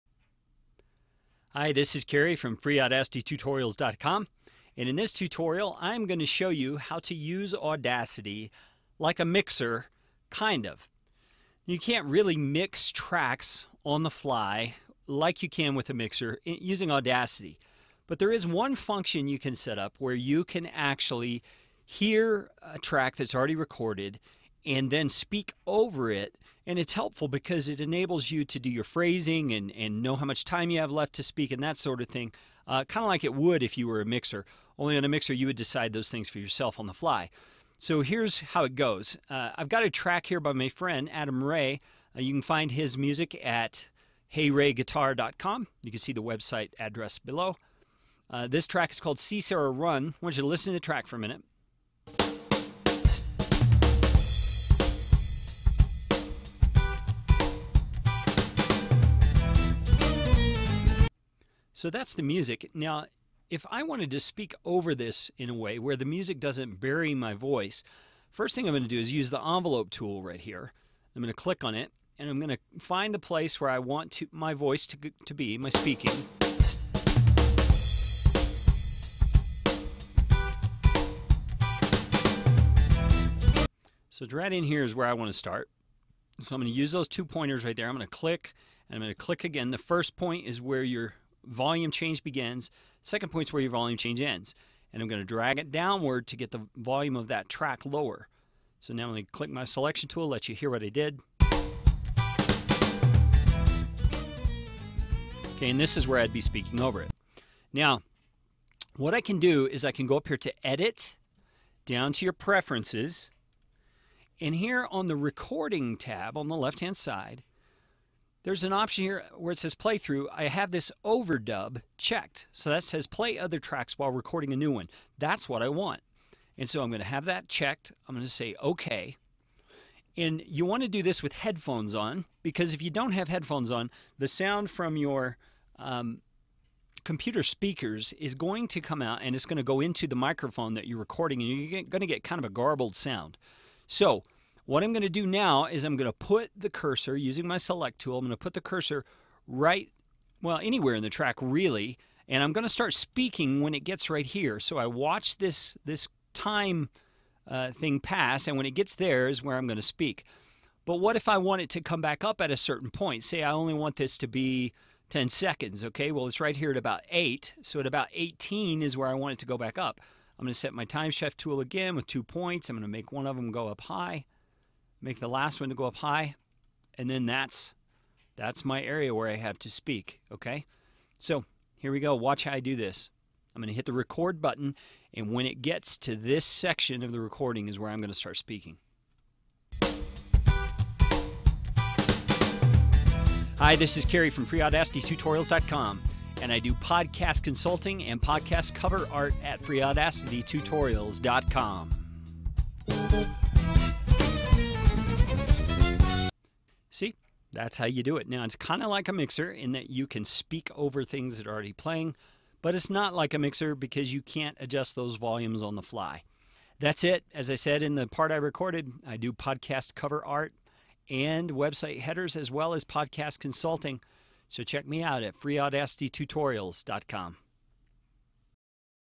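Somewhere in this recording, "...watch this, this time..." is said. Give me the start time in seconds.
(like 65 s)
154 s.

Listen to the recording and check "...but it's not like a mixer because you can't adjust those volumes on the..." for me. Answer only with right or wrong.
right.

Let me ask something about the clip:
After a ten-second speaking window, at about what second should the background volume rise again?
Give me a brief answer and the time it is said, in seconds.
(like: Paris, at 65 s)
18, at 168 s.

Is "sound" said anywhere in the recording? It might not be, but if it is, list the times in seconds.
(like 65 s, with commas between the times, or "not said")
134 s, 142 s.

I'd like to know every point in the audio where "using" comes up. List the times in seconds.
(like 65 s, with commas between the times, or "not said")
16 s, 147 s.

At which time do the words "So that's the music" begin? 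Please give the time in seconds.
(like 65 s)
61 s.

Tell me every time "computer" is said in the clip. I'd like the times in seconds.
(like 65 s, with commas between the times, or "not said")
137 s.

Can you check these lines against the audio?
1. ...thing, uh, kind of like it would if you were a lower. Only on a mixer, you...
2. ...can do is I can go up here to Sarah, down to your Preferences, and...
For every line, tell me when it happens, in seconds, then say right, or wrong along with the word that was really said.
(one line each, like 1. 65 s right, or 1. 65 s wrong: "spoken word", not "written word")
1. 32 s wrong: "mixer", not "lower"
2. 109 s wrong: "Edit", not "Sarah".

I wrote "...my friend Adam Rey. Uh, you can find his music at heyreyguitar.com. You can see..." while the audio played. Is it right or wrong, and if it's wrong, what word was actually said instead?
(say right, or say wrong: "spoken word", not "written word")
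right.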